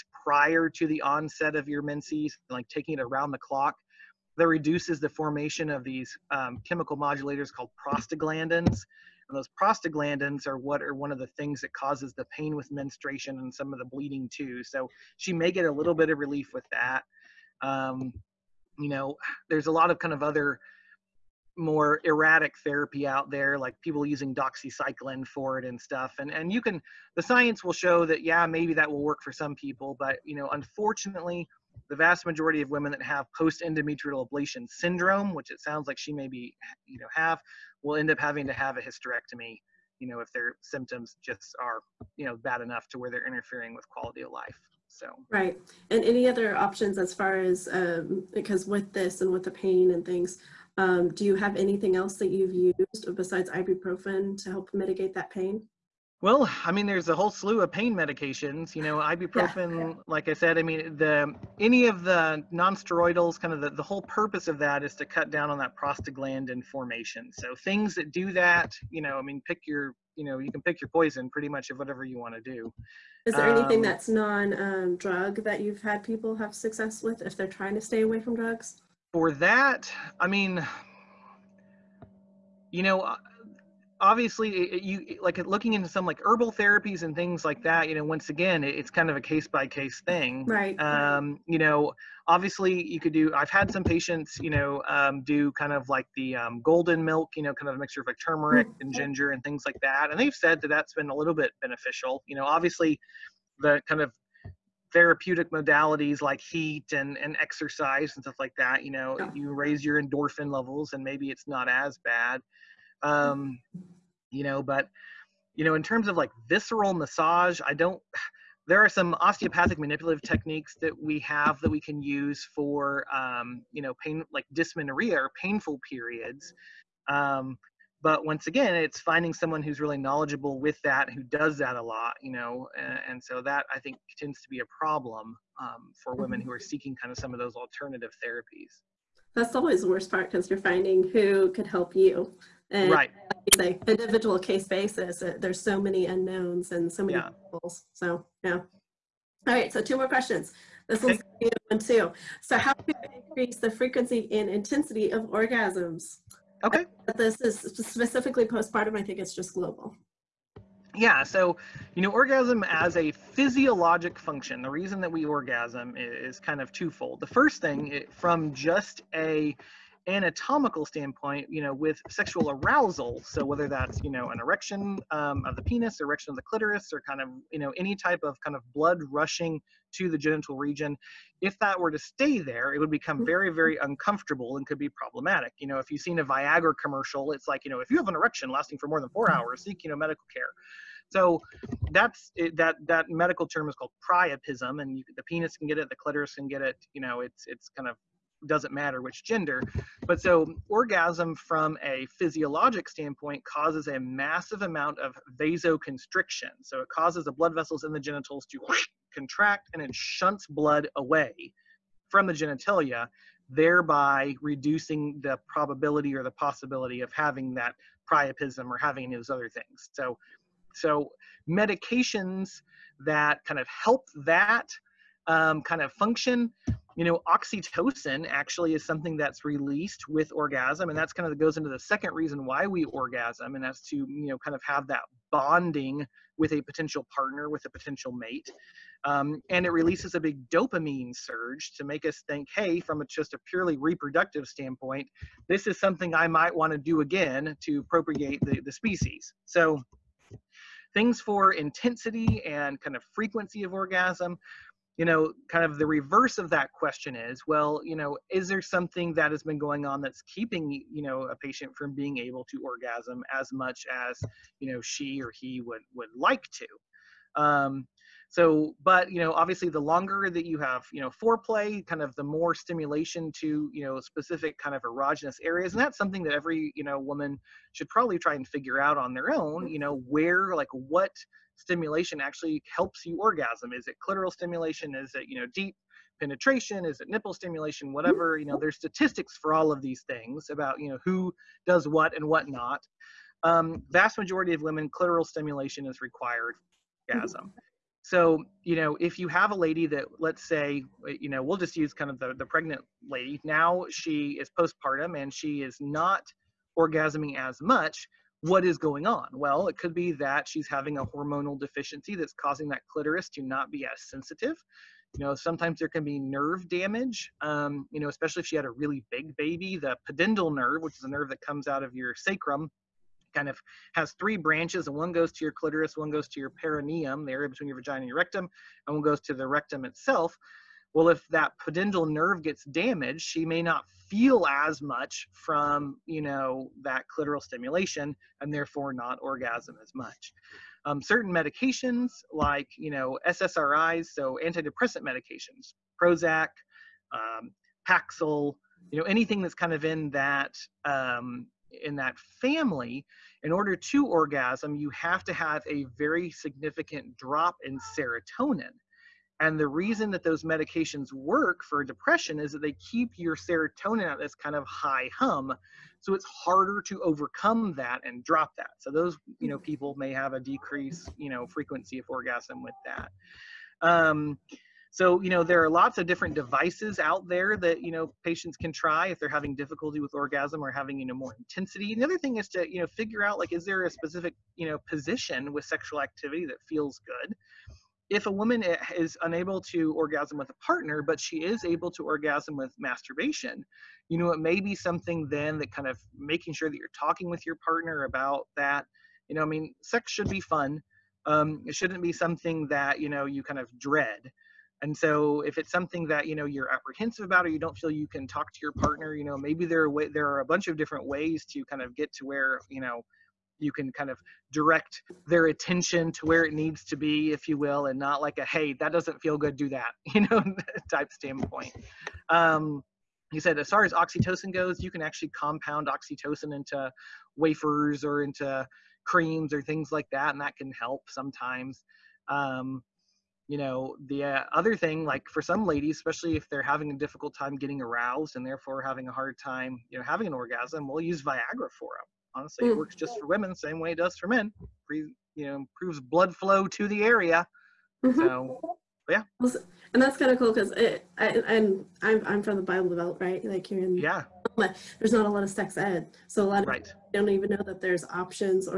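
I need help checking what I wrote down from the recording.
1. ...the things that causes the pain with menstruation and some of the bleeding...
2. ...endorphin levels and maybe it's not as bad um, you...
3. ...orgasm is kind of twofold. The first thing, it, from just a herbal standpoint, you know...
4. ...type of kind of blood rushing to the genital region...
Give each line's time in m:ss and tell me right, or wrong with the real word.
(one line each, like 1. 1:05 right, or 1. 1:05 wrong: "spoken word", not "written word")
1. 0:11 right
2. 1:50 right
3. 2:45 wrong: "anatomical", not "herbal"
4. 2:57 right.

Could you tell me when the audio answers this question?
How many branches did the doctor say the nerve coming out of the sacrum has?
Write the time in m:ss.
5:24.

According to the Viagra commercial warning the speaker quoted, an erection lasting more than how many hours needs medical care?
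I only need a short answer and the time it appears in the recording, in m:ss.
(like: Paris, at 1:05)
4, at 3:09.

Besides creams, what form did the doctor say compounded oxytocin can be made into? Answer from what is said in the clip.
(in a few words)
Wafers.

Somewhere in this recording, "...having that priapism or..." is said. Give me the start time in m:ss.
3:37.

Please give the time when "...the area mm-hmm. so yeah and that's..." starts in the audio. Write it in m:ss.
7:26.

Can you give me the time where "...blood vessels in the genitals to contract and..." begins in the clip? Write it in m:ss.
3:27.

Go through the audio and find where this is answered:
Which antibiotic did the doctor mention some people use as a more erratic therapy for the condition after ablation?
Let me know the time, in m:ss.
0:24.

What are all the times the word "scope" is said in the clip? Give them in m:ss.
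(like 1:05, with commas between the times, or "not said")
not said.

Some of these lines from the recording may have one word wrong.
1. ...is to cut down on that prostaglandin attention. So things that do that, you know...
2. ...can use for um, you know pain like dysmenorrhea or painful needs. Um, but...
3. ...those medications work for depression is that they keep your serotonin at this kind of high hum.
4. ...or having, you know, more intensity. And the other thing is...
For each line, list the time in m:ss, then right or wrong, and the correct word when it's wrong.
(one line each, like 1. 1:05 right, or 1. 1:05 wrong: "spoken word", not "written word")
1. 1:04 wrong: "formation", not "attention"
2. 2:01 wrong: "periods", not "needs"
3. 6:00 right
4. 6:20 right.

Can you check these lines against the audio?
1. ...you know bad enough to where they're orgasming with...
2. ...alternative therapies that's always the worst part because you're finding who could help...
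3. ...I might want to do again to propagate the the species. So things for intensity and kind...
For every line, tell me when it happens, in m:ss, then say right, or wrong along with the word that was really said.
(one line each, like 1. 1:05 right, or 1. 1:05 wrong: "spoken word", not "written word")
1. 0:42 wrong: "interfering", not "orgasming"
2. 2:17 right
3. 4:06 right.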